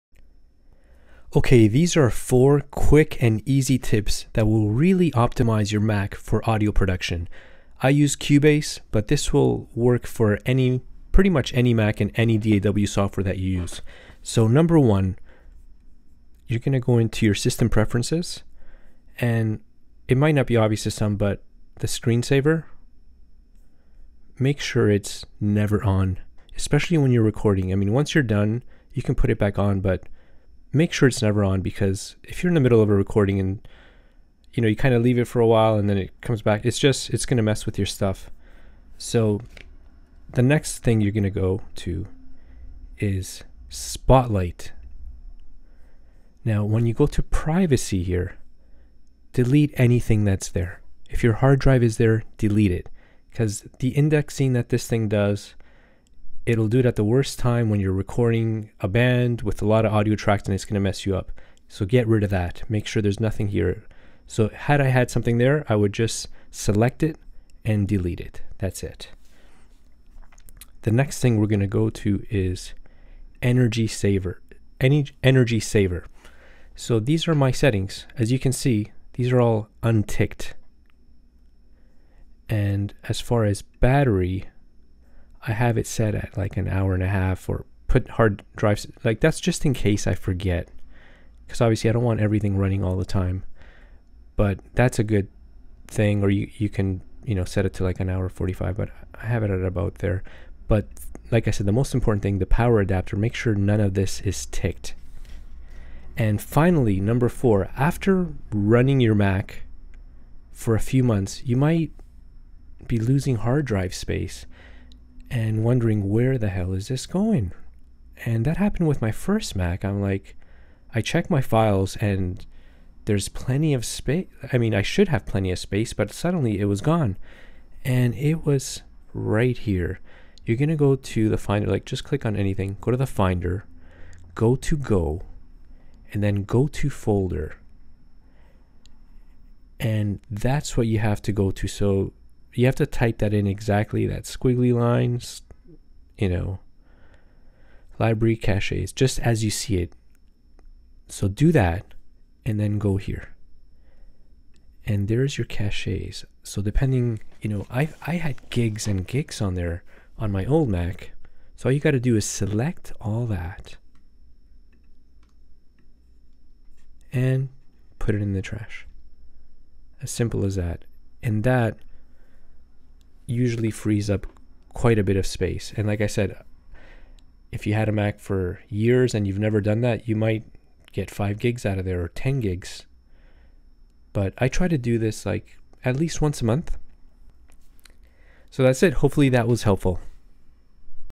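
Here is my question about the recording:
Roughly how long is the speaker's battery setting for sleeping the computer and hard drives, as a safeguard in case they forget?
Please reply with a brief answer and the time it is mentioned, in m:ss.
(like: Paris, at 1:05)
an hour and a half, at 1:26.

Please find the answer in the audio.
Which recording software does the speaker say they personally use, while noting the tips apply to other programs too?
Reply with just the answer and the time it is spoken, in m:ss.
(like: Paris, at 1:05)
Cubase, at 0:08.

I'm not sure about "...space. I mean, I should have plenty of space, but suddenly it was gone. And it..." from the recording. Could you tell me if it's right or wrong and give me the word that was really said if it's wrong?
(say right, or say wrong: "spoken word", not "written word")
right.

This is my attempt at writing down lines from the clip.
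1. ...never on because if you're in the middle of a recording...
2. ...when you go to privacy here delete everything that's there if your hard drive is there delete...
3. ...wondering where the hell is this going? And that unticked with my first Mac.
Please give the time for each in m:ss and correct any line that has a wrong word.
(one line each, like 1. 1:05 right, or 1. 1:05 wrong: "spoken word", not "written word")
1. 0:31 right
2. 0:46 wrong: "anything", not "everything"
3. 1:55 wrong: "happened", not "unticked".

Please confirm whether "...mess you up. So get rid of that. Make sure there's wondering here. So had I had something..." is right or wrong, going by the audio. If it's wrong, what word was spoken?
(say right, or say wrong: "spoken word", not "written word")
wrong: "nothing", not "wondering".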